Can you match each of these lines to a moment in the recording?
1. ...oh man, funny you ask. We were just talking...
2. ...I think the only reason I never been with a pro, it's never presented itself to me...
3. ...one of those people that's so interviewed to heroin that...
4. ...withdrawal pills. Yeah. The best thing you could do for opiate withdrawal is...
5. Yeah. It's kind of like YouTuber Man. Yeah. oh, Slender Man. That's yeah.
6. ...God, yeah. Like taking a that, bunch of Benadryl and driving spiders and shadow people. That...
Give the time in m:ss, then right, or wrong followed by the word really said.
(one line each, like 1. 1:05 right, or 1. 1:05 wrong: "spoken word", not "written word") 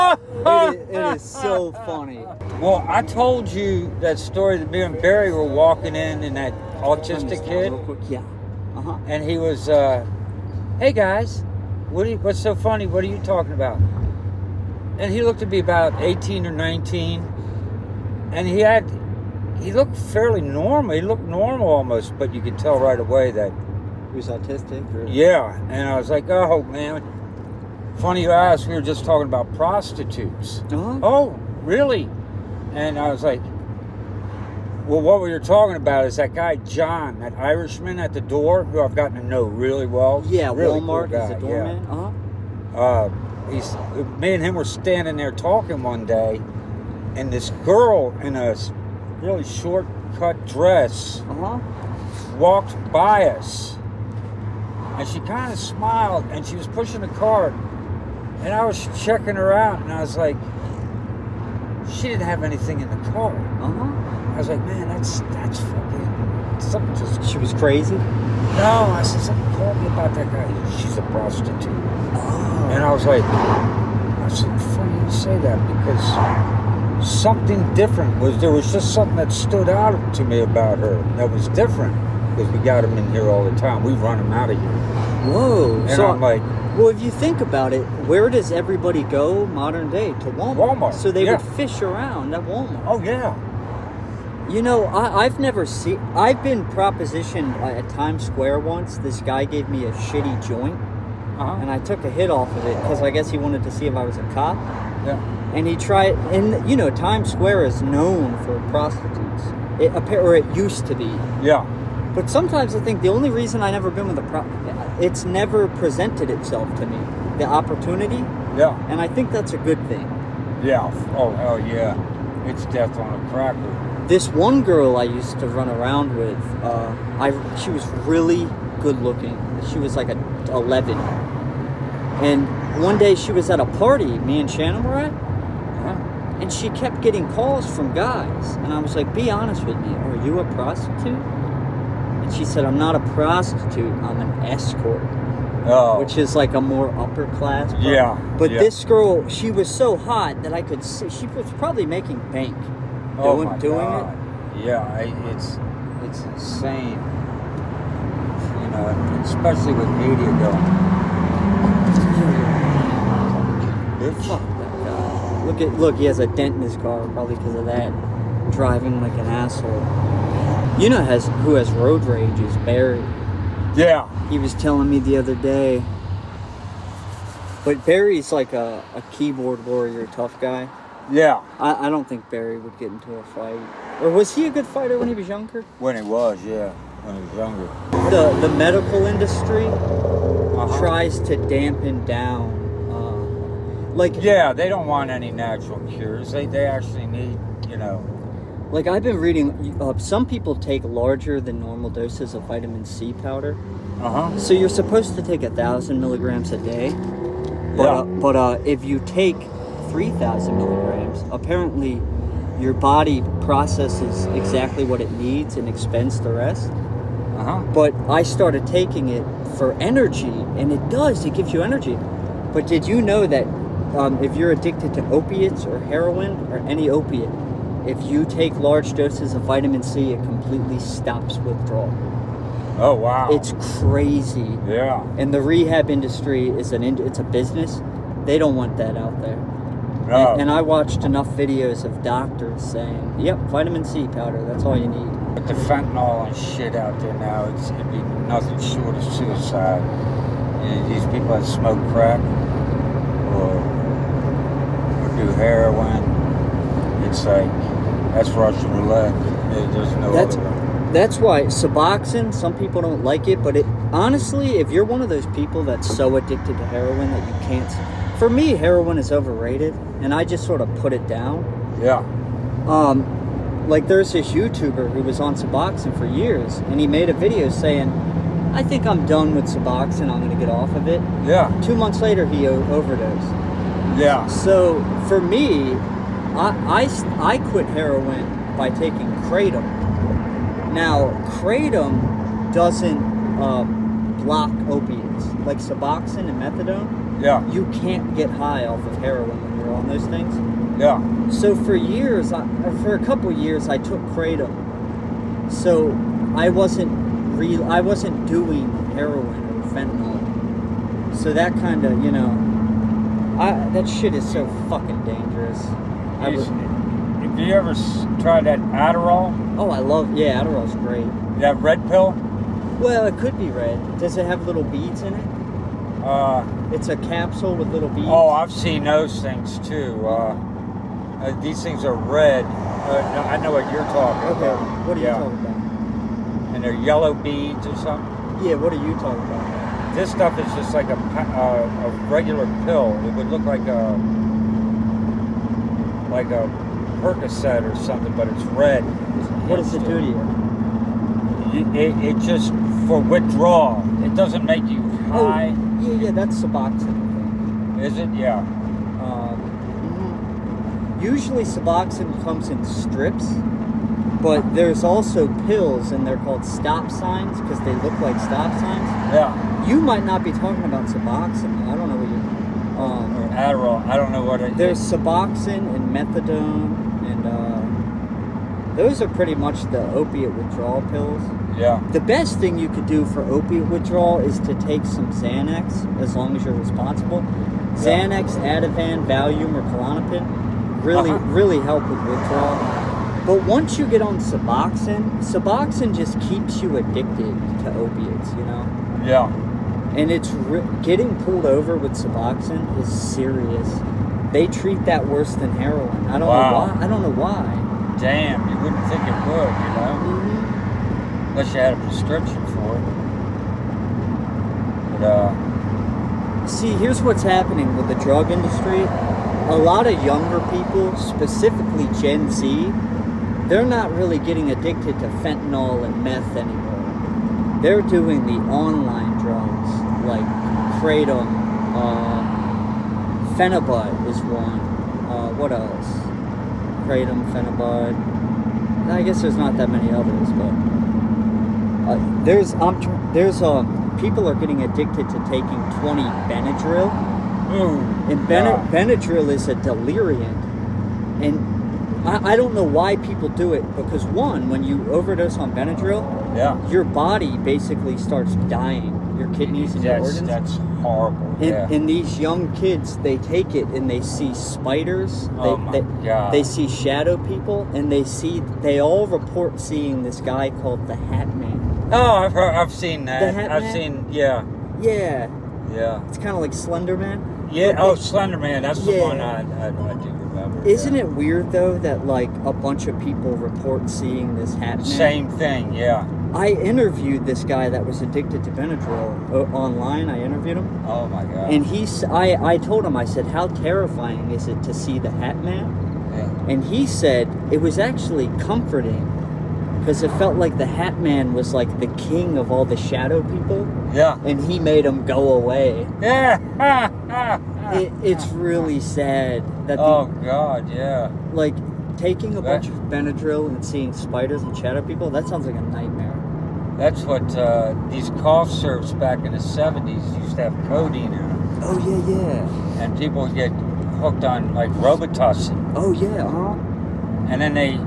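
1. 0:26 right
2. 1:52 right
3. 4:24 wrong: "addicted", not "interviewed"
4. 6:20 right
5. 7:55 wrong: "Slender", not "YouTuber"
6. 8:30 wrong: "seeing", not "driving".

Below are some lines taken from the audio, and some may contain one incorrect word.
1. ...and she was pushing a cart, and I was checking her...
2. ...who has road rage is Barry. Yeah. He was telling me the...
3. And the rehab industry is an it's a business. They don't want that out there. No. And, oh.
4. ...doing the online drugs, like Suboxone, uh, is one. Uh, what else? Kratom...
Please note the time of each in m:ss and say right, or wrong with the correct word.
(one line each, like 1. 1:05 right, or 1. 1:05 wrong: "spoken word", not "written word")
1. 0:56 right
2. 2:51 right
3. 3:55 right
4. 7:07 wrong: "Kratom", not "Suboxone".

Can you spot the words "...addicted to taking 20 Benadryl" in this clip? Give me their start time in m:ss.
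7:24.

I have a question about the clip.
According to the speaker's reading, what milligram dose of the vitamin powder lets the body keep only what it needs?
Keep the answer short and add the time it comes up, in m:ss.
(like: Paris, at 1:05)
3,000, at 3:29.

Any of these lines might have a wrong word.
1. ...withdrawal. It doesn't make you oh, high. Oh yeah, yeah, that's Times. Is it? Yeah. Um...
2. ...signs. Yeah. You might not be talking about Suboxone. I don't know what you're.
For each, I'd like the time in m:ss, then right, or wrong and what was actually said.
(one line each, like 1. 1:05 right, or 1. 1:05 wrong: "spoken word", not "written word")
1. 5:53 wrong: "Suboxone", not "Times"
2. 6:08 right.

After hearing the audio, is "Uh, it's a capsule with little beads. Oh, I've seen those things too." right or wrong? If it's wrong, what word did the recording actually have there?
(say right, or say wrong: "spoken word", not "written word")
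right.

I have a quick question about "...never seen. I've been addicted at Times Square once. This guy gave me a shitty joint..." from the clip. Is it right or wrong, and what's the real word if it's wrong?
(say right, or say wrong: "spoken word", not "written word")
wrong: "propositioned", not "addicted".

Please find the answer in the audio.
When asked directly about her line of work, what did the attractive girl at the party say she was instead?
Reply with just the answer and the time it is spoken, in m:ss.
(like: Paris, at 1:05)
An escort, at 2:24.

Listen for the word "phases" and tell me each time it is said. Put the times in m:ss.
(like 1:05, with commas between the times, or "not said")
not said.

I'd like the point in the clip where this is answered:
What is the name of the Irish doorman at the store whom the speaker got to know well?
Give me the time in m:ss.
0:36.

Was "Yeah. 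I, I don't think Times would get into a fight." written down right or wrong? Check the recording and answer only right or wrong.
wrong.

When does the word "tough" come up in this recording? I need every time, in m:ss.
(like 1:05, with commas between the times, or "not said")
3:00.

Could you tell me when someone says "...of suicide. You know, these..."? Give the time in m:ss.
4:08.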